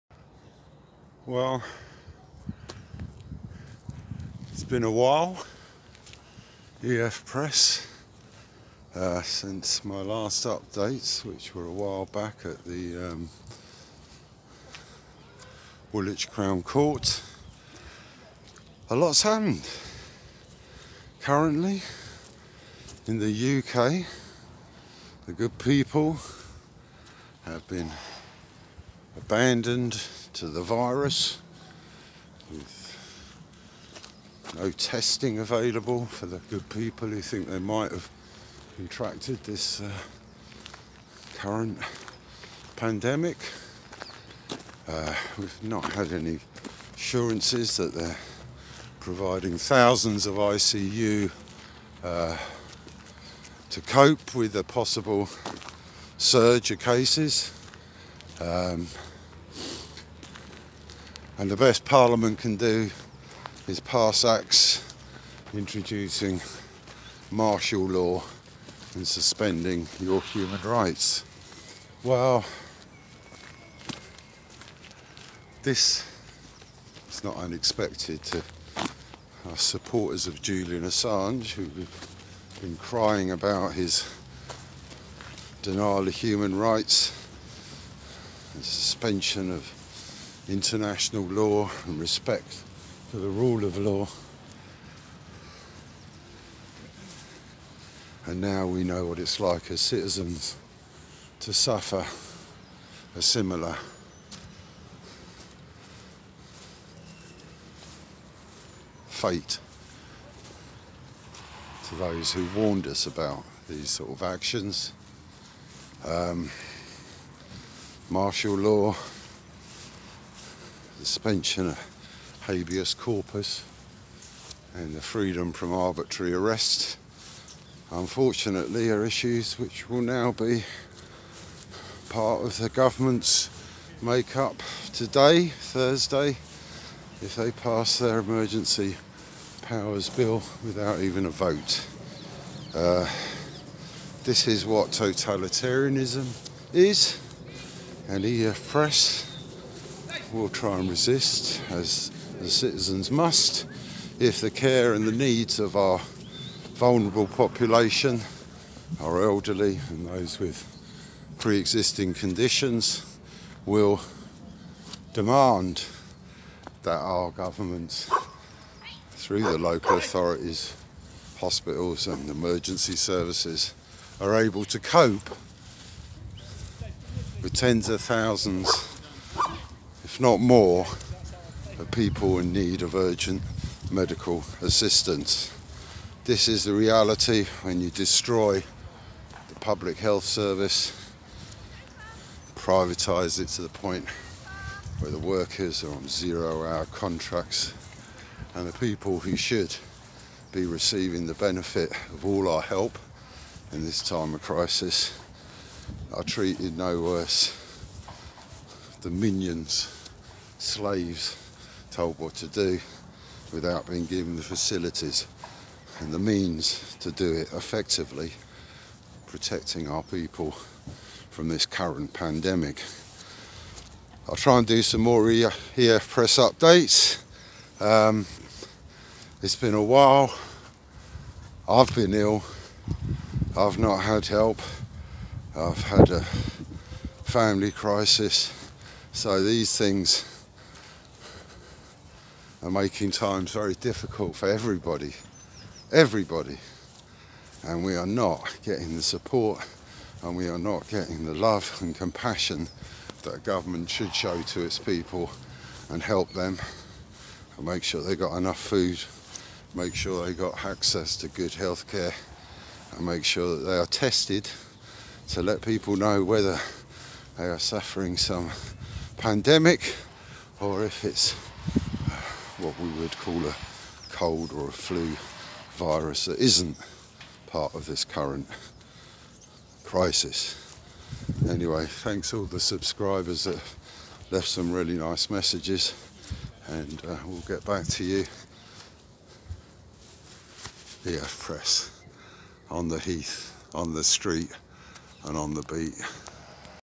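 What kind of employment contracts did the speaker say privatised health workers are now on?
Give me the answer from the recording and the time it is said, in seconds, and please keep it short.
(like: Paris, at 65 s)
zero hour contracts, at 196 s.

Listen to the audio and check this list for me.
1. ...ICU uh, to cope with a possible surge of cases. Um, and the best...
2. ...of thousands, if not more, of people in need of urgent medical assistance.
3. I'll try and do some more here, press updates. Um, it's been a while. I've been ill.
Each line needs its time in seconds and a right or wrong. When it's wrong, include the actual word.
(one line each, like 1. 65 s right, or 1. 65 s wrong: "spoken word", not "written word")
1. 50 s right
2. 177 s right
3. 224 s right.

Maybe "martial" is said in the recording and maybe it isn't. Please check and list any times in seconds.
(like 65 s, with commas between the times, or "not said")
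67 s, 118 s.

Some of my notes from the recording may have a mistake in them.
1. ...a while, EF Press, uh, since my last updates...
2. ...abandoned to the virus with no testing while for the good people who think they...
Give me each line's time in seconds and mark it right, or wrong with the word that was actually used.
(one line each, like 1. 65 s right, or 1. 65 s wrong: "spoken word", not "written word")
1. 4 s right
2. 29 s wrong: "available", not "while".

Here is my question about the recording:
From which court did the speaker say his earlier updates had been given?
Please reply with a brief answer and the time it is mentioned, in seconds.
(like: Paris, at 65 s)
Woolwich Crown Court, at 15 s.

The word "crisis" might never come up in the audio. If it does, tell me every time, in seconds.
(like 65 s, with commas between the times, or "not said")
204 s, 237 s, 279 s.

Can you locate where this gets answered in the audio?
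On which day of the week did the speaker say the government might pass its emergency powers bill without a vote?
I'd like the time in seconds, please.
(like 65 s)
135 s.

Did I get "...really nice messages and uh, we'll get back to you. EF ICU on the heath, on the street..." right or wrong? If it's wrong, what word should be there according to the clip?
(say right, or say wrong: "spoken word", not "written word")
wrong: "Press", not "ICU".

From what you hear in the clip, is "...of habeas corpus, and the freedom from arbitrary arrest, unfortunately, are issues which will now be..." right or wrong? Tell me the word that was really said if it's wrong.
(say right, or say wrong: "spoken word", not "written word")
right.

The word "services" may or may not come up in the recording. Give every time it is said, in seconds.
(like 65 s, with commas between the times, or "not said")
172 s, 190 s.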